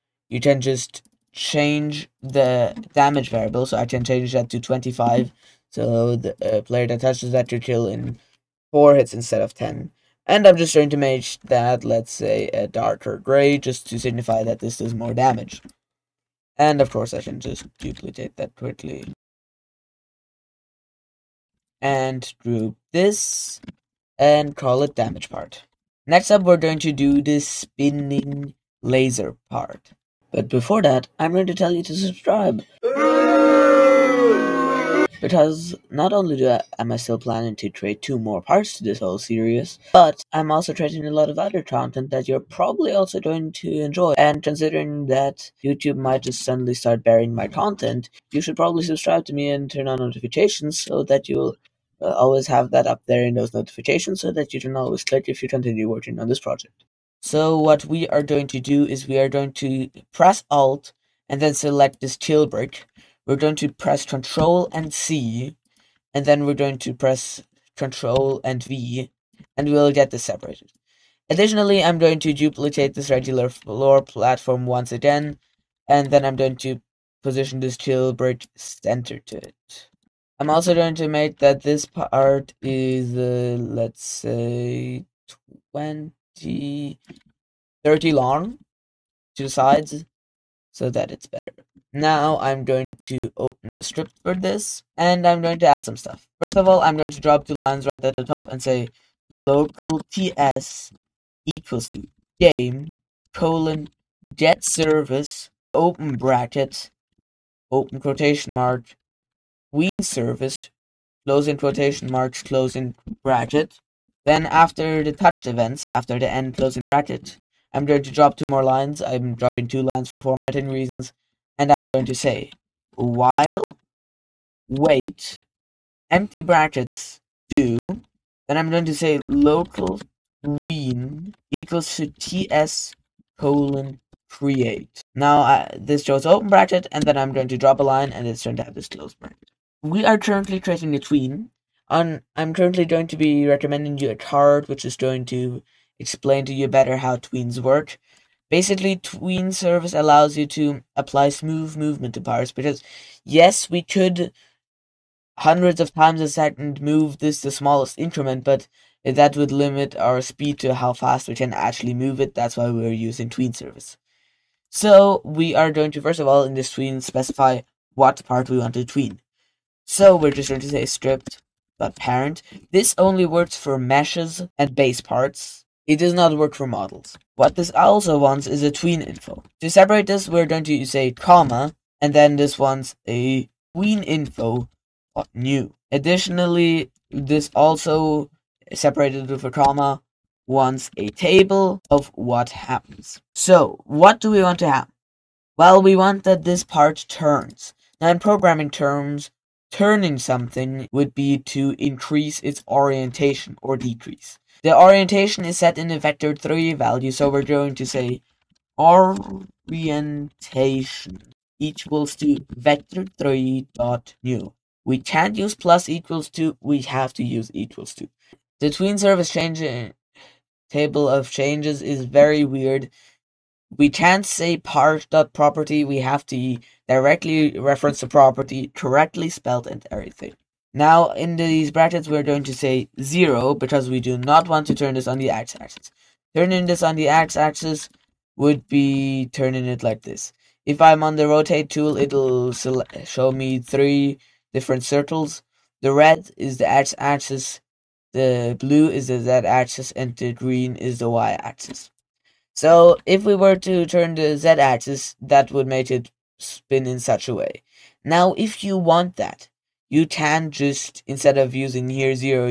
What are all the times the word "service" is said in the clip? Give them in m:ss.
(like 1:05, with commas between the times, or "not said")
1:44, 1:50, 2:29, 2:43, 3:38.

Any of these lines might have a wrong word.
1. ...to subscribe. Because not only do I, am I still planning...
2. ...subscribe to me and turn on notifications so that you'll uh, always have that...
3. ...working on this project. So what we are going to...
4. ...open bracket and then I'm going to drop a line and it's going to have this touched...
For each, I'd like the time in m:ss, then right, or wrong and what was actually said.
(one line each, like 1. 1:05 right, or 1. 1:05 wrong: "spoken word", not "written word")
1. 0:31 right
2. 0:48 right
3. 0:55 right
4. 2:16 wrong: "closed", not "touched".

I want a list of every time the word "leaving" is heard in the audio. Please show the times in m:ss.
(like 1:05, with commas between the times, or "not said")
not said.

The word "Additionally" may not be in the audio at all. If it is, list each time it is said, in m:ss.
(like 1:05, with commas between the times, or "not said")
1:11, 3:05.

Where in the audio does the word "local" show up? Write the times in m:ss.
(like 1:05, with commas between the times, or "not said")
1:39, 2:09.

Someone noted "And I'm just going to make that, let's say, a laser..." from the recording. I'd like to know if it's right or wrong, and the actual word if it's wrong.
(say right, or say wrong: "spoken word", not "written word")
wrong: "darker", not "laser".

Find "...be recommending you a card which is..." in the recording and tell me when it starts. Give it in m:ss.
2:23.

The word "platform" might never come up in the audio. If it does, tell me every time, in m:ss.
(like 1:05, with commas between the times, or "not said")
1:14.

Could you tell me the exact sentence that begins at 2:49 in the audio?
So we're just going to say script apparent.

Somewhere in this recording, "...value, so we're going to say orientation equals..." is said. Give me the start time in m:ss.
3:26.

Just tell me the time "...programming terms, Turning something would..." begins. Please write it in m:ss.
3:18.